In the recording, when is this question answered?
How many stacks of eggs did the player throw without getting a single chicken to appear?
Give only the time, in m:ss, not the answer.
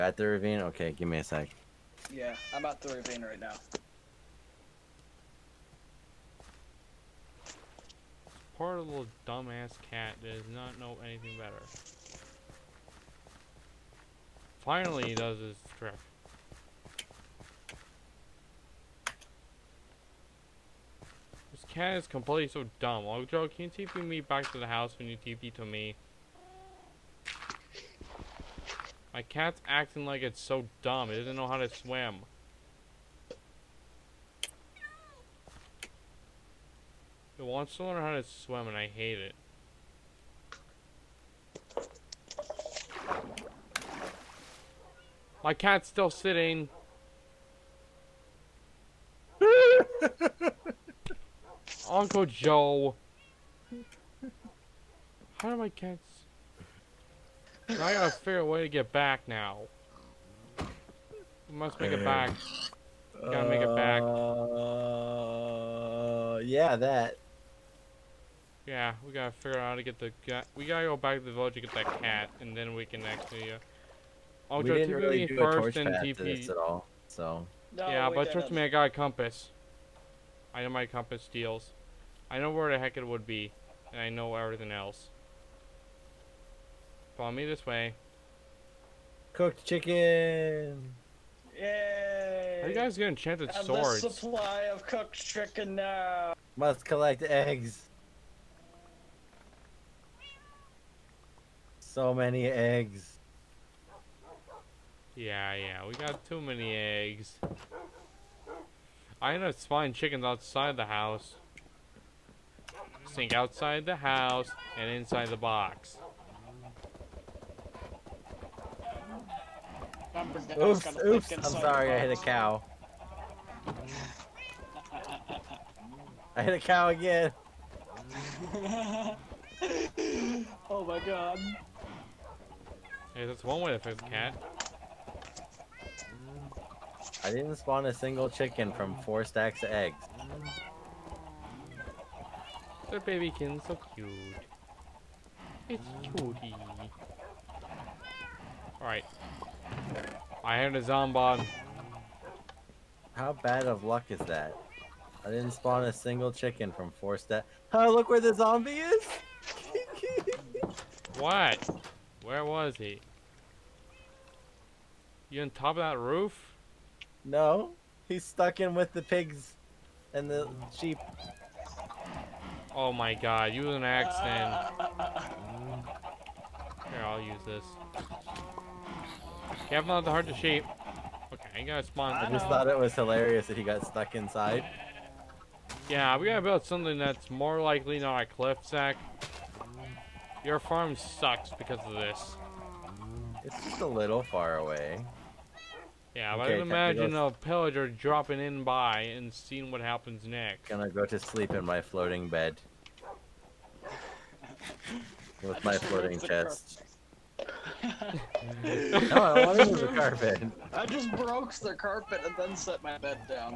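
2:19.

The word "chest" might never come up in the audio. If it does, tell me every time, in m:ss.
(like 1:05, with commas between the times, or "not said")
3:26.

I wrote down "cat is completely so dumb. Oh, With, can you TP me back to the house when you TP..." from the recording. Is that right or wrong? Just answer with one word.
wrong.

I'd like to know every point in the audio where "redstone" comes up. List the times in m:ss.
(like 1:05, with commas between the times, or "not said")
not said.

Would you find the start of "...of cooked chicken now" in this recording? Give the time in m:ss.
1:34.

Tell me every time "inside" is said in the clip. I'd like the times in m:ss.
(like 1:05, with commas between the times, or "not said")
1:54, 3:04.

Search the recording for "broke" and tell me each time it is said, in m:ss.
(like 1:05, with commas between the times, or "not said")
3:31.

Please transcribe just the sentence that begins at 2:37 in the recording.
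Oh, look where the zombie is!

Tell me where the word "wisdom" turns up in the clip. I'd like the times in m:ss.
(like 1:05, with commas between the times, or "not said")
not said.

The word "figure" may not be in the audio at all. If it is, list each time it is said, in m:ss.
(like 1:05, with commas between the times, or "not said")
0:58, 1:09.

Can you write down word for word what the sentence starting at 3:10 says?
Your farm sucks because of this.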